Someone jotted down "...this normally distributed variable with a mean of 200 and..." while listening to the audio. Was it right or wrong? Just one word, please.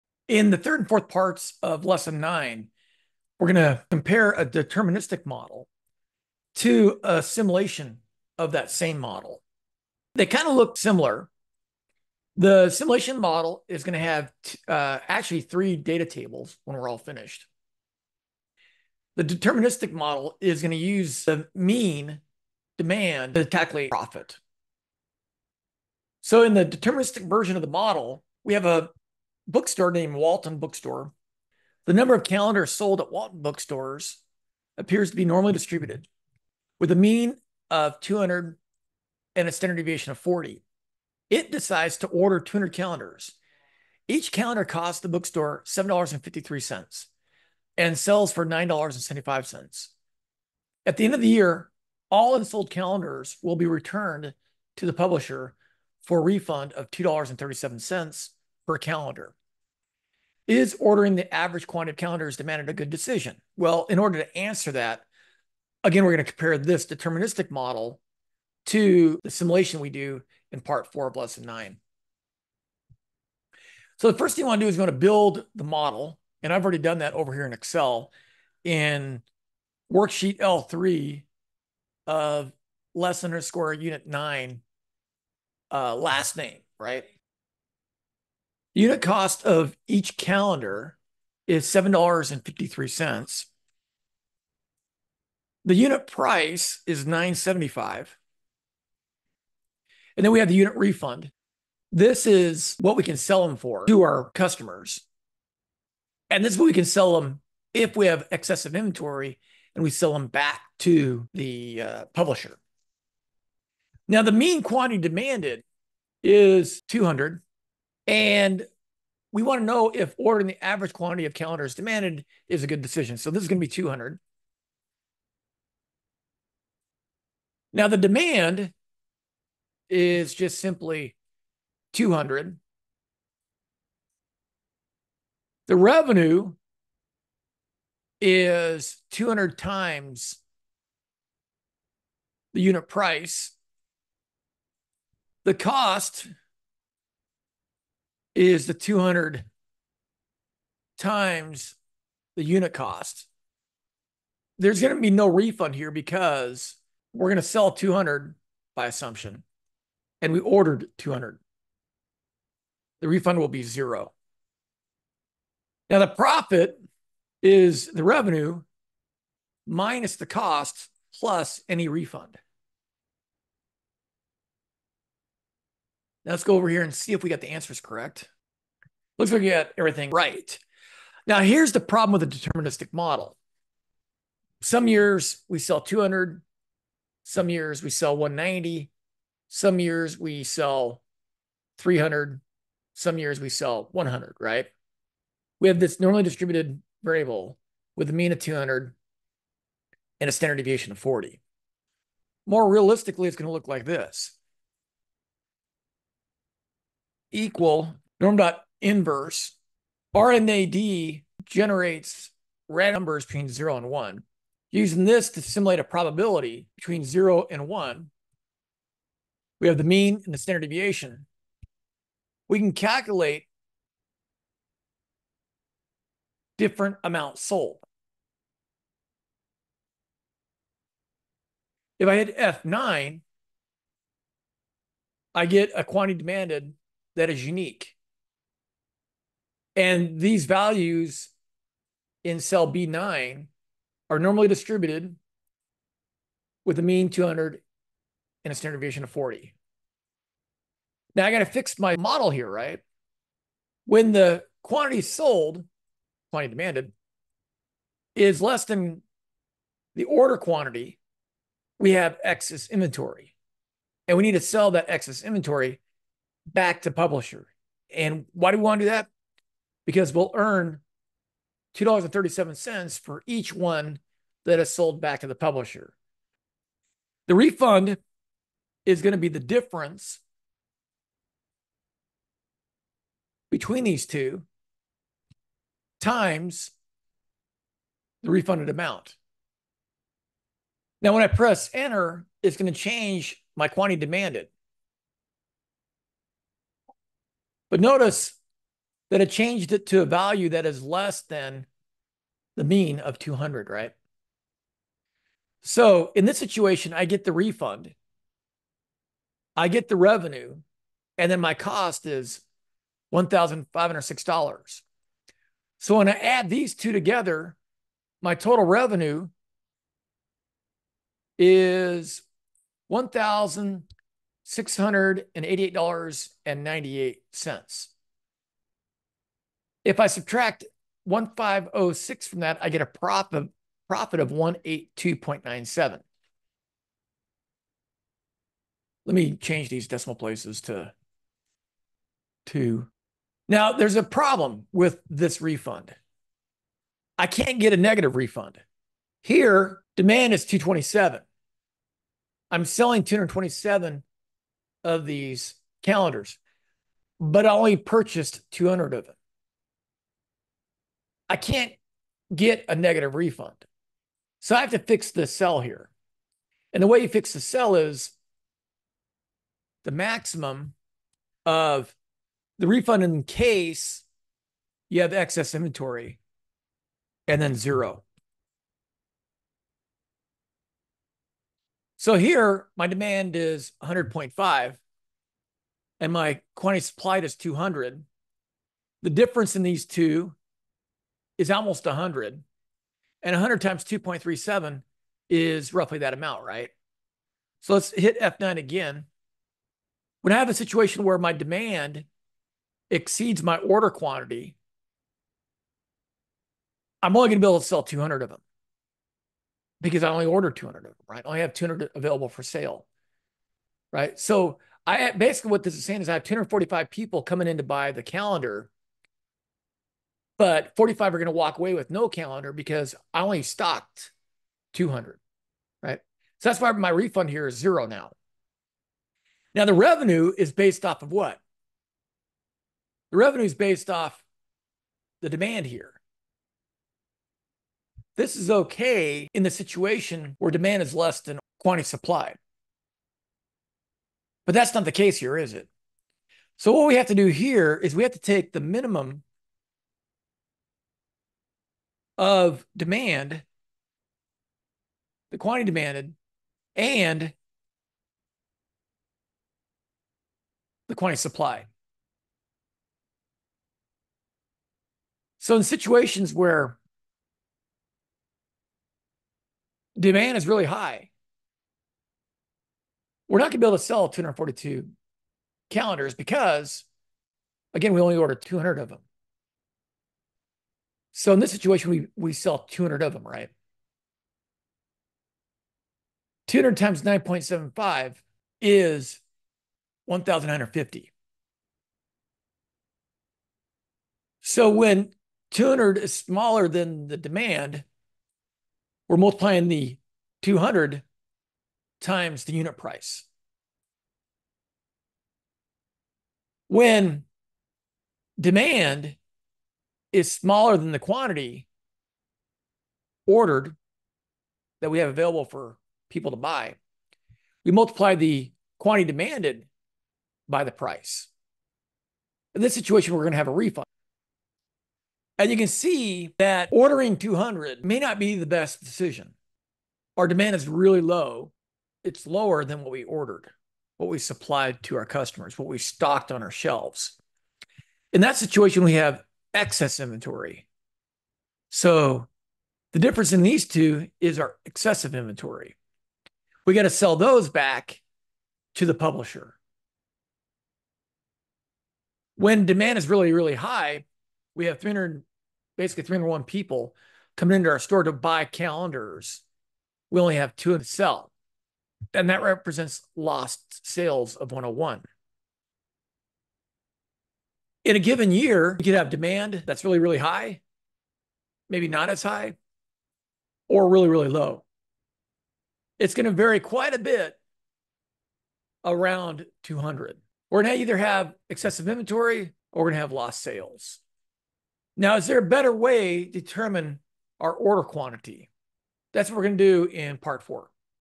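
right.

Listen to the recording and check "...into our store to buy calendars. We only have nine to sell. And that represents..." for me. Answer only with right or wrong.
wrong.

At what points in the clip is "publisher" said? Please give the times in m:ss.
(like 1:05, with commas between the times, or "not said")
0:54, 1:52, 4:26, 4:35, 9:08.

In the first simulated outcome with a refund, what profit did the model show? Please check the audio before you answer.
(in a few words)
182.97.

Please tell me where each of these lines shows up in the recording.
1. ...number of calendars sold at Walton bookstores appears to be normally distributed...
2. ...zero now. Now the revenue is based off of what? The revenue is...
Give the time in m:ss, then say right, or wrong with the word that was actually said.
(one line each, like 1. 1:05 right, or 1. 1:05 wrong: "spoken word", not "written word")
1. 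0:31 right
2. 7:07 right.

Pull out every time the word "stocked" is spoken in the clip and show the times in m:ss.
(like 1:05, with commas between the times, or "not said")
7:03, 8:55.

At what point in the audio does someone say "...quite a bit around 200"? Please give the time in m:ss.
9:36.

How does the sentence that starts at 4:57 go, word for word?
But notice that it changed it to a value that is less than the mean of 200, right?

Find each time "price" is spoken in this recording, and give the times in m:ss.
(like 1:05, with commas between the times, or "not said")
1:36, 2:22, 8:22, 8:40.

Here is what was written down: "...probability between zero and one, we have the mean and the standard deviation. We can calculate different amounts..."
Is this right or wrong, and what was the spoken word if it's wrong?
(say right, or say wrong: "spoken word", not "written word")
right.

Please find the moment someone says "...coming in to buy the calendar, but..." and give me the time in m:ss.
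6:57.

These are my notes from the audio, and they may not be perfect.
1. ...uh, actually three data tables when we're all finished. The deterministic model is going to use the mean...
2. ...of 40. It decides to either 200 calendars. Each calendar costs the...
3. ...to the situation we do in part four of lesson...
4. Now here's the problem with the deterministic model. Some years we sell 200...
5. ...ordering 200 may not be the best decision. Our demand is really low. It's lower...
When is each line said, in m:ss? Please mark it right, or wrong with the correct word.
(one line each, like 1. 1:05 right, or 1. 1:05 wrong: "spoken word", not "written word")
1. 0:14 right
2. 0:40 wrong: "order", not "either"
3. 1:08 wrong: "simulation", not "situation"
4. 3:01 right
5. 8:46 right.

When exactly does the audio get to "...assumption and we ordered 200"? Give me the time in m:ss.
2:38.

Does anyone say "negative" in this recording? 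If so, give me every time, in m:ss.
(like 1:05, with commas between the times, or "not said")
5:47, 6:02.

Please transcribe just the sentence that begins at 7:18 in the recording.
This is okay in the situation where demand is less than quantity supplied.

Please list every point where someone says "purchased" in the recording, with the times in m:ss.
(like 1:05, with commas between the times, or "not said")
5:57.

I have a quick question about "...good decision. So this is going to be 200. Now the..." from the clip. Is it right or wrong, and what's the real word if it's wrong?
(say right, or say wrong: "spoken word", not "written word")
right.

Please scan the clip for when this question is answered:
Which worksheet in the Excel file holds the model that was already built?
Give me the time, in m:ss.
1:20.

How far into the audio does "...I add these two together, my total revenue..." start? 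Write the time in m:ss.
5:16.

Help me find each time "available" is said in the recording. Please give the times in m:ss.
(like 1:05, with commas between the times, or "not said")
6:51, 8:35.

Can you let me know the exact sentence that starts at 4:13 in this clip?
When the quantity sold, quantity demanded, is less than the order quantity, we have excess inventory.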